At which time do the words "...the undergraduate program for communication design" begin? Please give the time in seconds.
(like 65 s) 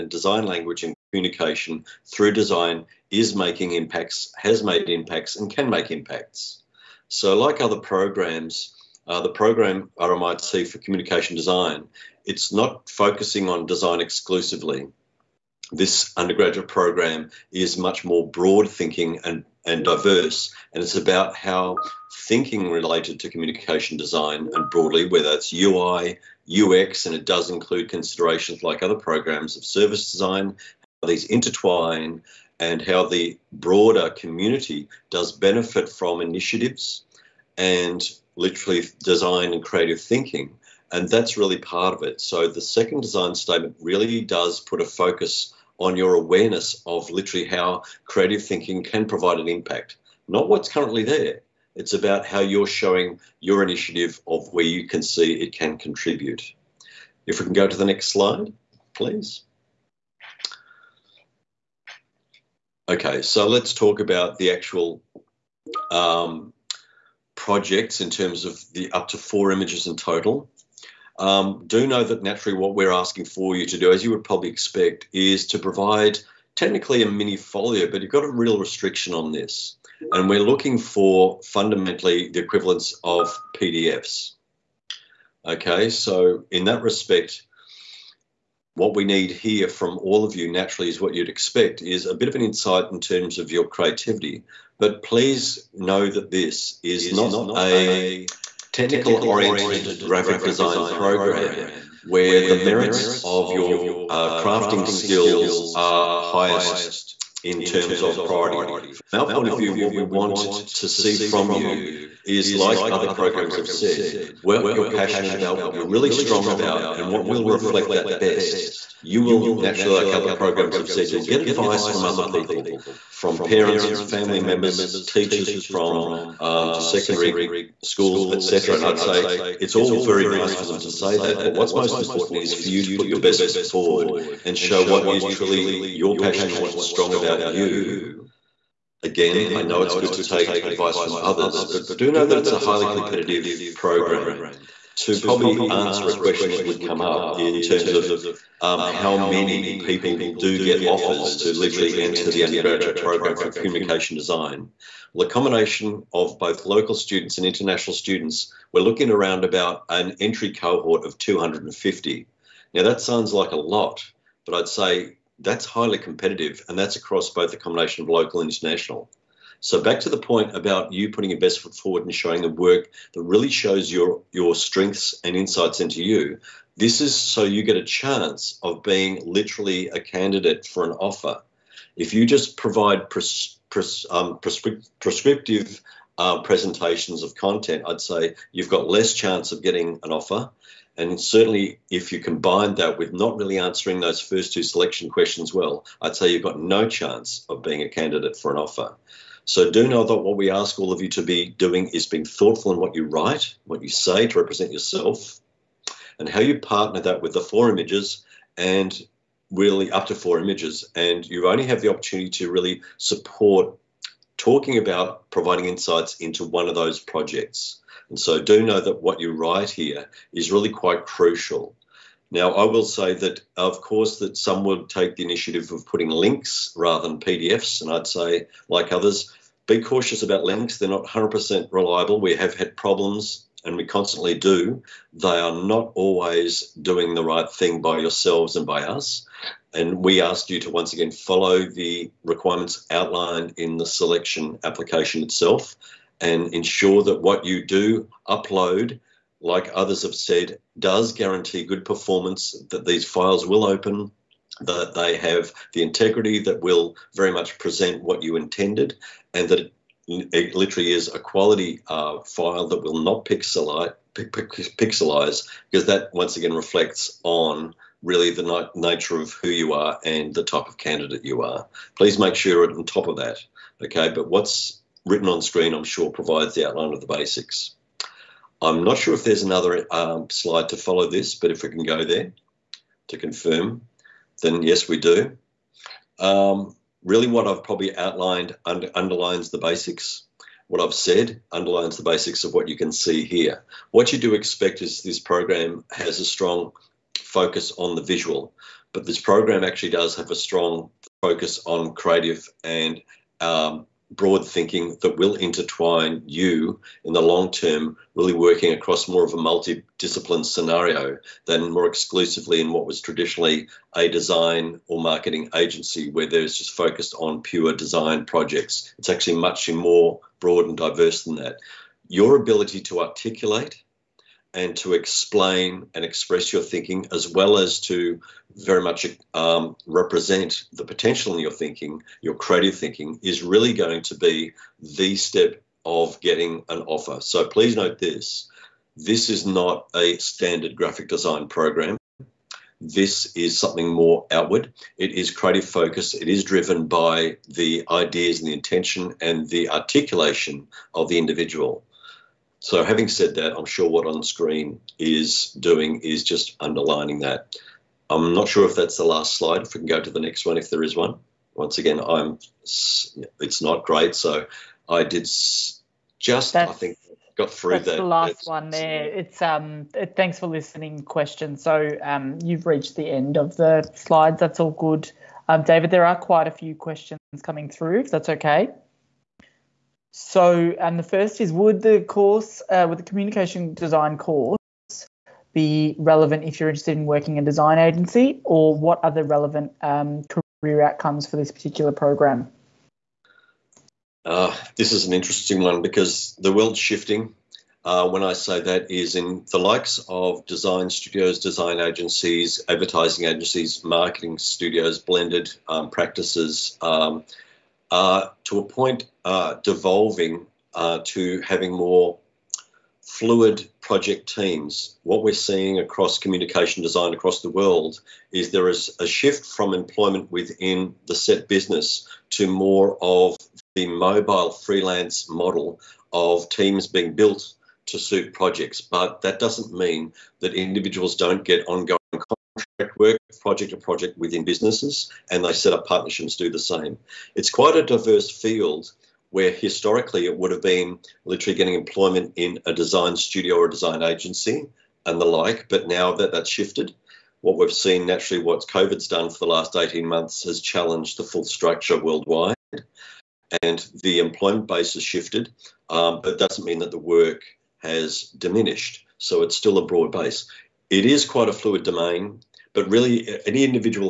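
152 s.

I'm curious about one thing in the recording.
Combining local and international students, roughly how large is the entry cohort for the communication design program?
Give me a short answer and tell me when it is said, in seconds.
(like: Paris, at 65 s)
250, at 161 s.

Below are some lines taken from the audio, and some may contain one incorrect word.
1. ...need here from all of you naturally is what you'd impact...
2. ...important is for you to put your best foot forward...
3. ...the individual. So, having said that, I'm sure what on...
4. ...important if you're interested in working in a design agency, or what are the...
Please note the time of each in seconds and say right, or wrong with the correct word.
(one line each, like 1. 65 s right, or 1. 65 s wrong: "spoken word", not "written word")
1. 89 s wrong: "expect", not "impact"
2. 131 s right
3. 351 s right
4. 385 s wrong: "relevant", not "important".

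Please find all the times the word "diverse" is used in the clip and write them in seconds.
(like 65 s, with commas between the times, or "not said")
19 s, 320 s, 437 s.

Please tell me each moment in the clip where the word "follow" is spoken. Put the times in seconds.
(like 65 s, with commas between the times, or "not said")
241 s, 280 s.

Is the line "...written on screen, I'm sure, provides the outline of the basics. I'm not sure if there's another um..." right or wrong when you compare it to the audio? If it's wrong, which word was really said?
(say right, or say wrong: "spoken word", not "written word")
right.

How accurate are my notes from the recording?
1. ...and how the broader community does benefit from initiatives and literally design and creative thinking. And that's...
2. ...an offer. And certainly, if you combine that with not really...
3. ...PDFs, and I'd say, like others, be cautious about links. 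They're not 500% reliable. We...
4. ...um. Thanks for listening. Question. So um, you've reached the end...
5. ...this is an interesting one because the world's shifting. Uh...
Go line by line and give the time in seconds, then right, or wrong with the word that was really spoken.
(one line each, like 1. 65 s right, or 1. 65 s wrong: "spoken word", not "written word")
1. 32 s right
2. 190 s right
3. 227 s wrong: "100", not "500"
4. 369 s right
5. 394 s right.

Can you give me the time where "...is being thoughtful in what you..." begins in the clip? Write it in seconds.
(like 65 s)
201 s.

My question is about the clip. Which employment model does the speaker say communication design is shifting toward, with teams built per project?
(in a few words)
mobile freelance model.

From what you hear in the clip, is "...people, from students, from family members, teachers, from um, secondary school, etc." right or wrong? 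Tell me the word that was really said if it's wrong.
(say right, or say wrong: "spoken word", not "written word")
wrong: "parents", not "students".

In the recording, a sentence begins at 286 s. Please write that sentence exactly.
Um, really, what I've probably outlined under, underlines the basics.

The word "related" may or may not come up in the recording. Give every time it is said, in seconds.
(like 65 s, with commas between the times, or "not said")
22 s.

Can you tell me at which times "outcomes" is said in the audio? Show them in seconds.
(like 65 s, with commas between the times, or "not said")
390 s.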